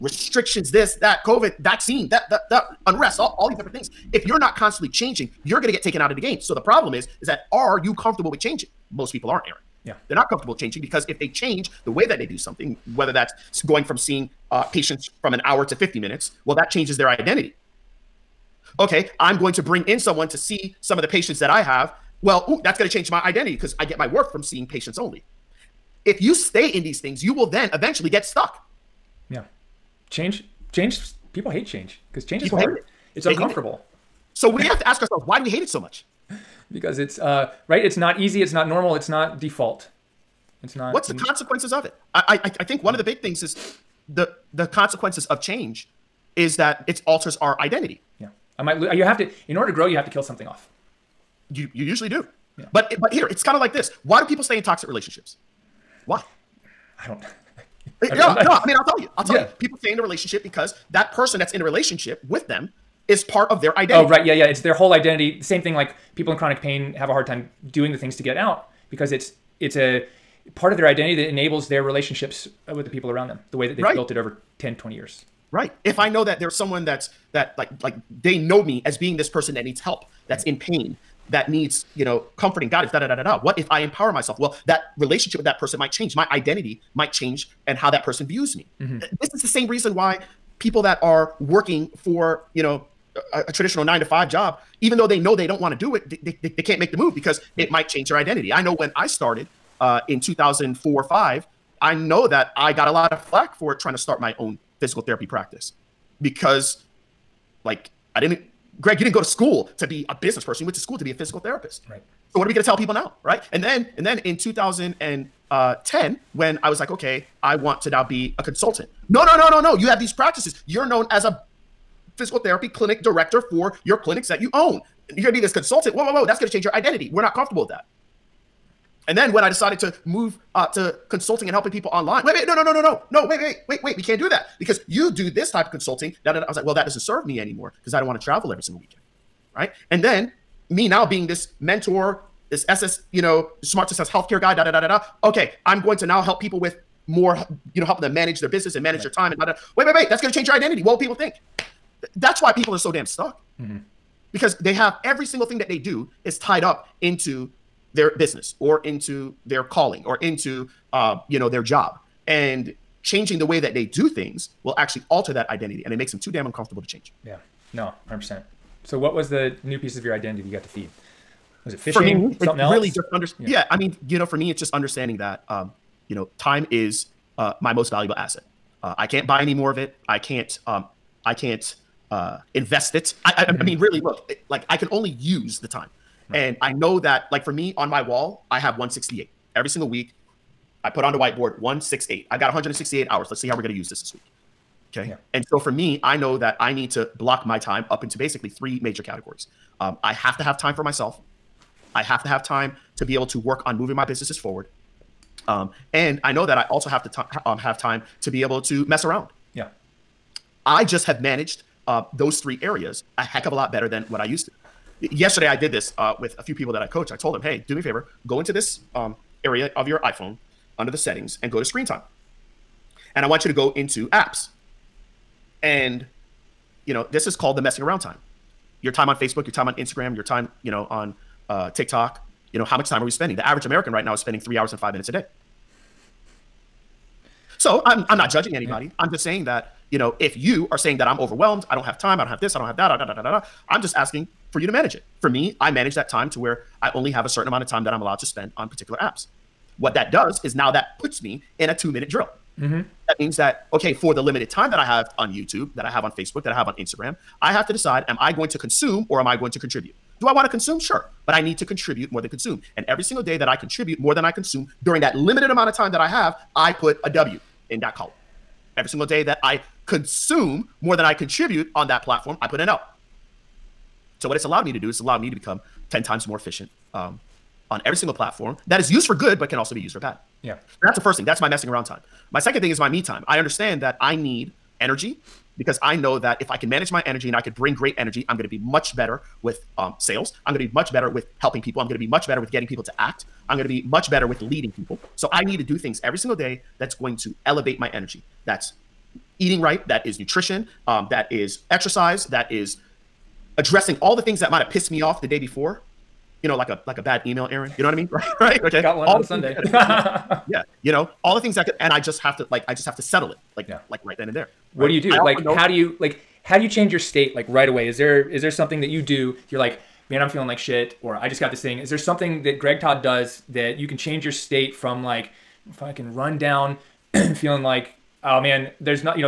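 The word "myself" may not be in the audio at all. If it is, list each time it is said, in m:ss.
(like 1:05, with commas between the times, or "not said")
1:24, 3:20.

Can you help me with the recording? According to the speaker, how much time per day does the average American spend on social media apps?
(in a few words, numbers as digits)
3 hours and 5 minutes.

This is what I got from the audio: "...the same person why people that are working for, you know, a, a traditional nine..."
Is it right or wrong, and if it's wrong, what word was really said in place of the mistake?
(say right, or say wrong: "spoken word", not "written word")
wrong: "reason", not "person".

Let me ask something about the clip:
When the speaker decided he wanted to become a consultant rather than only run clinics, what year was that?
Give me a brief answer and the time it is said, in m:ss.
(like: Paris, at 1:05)
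2010, at 1:54.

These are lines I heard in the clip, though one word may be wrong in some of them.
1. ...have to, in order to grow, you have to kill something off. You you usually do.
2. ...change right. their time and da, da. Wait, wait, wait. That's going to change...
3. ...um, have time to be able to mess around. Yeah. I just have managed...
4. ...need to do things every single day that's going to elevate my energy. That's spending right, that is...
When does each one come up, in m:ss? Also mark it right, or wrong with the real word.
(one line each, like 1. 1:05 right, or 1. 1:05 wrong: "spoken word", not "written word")
1. 0:49 right
2. 2:28 wrong: "manage", not "change"
3. 3:27 right
4. 4:55 wrong: "eating", not "spending".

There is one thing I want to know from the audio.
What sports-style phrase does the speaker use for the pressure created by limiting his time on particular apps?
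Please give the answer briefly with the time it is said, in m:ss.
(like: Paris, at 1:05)
two minute drill, at 4:11.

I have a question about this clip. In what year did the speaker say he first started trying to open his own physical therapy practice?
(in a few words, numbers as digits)
2004.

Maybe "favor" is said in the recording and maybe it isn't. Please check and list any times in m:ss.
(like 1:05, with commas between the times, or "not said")
3:37.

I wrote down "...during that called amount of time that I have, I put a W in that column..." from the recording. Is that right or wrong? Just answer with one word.
wrong.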